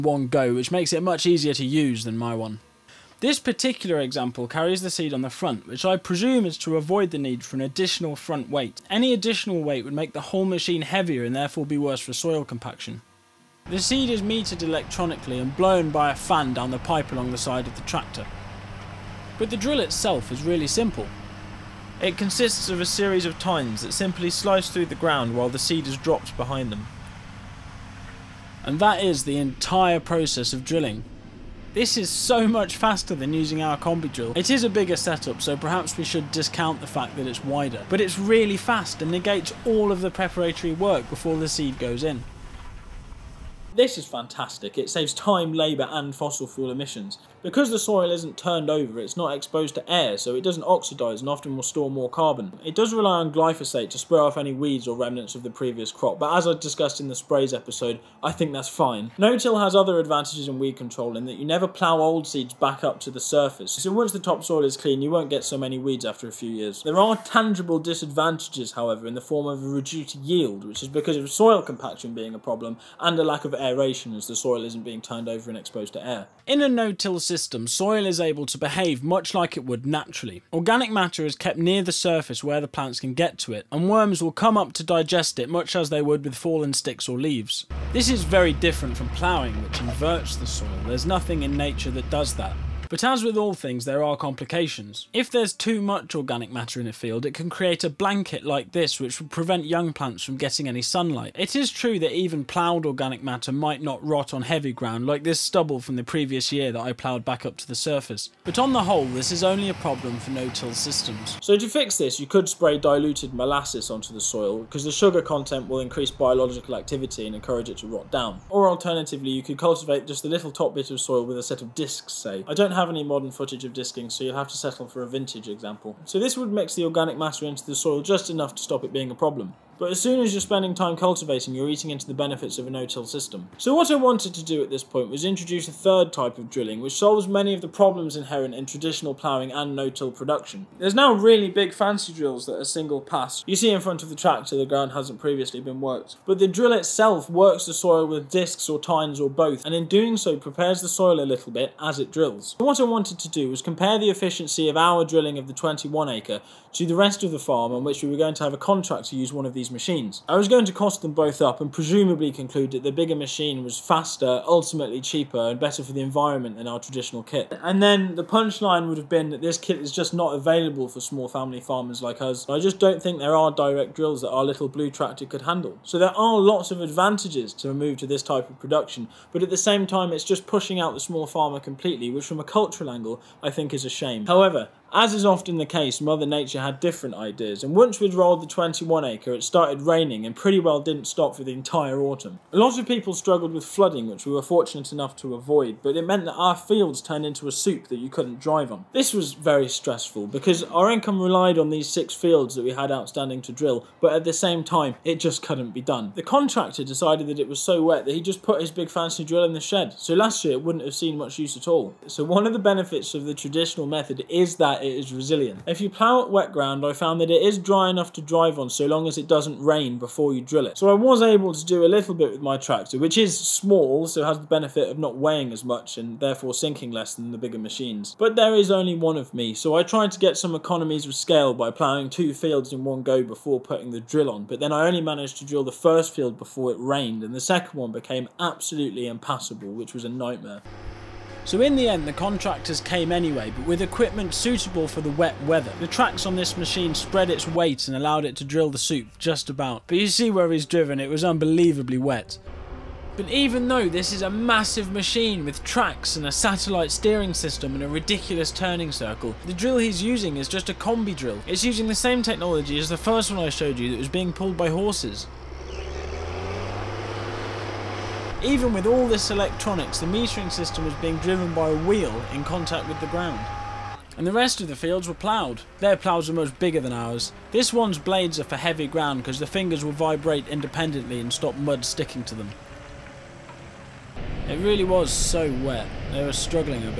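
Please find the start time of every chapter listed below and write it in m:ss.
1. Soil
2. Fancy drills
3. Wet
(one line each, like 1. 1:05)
1. 1:16
2. 2:14
3. 3:04.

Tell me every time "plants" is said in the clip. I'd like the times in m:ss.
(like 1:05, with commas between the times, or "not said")
1:22, 1:39.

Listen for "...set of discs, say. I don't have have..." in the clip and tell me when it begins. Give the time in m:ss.
2:01.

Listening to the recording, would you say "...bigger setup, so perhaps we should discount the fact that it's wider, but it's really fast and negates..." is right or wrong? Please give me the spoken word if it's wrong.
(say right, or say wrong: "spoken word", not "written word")
right.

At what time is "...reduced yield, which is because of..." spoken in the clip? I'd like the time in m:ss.
1:09.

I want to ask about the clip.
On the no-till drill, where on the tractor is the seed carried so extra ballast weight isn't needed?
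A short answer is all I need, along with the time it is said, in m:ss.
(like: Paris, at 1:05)
On the front, at 0:05.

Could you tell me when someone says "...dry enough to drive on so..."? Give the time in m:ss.
3:37.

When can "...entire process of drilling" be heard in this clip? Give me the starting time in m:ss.
0:29.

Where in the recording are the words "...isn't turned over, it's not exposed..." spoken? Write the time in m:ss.
0:48.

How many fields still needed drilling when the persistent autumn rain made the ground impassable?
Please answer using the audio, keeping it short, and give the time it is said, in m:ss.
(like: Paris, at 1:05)
6, at 3:21.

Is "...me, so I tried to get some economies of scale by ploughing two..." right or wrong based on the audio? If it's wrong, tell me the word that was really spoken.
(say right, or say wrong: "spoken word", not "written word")
right.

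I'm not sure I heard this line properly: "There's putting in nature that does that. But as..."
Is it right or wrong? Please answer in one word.
wrong.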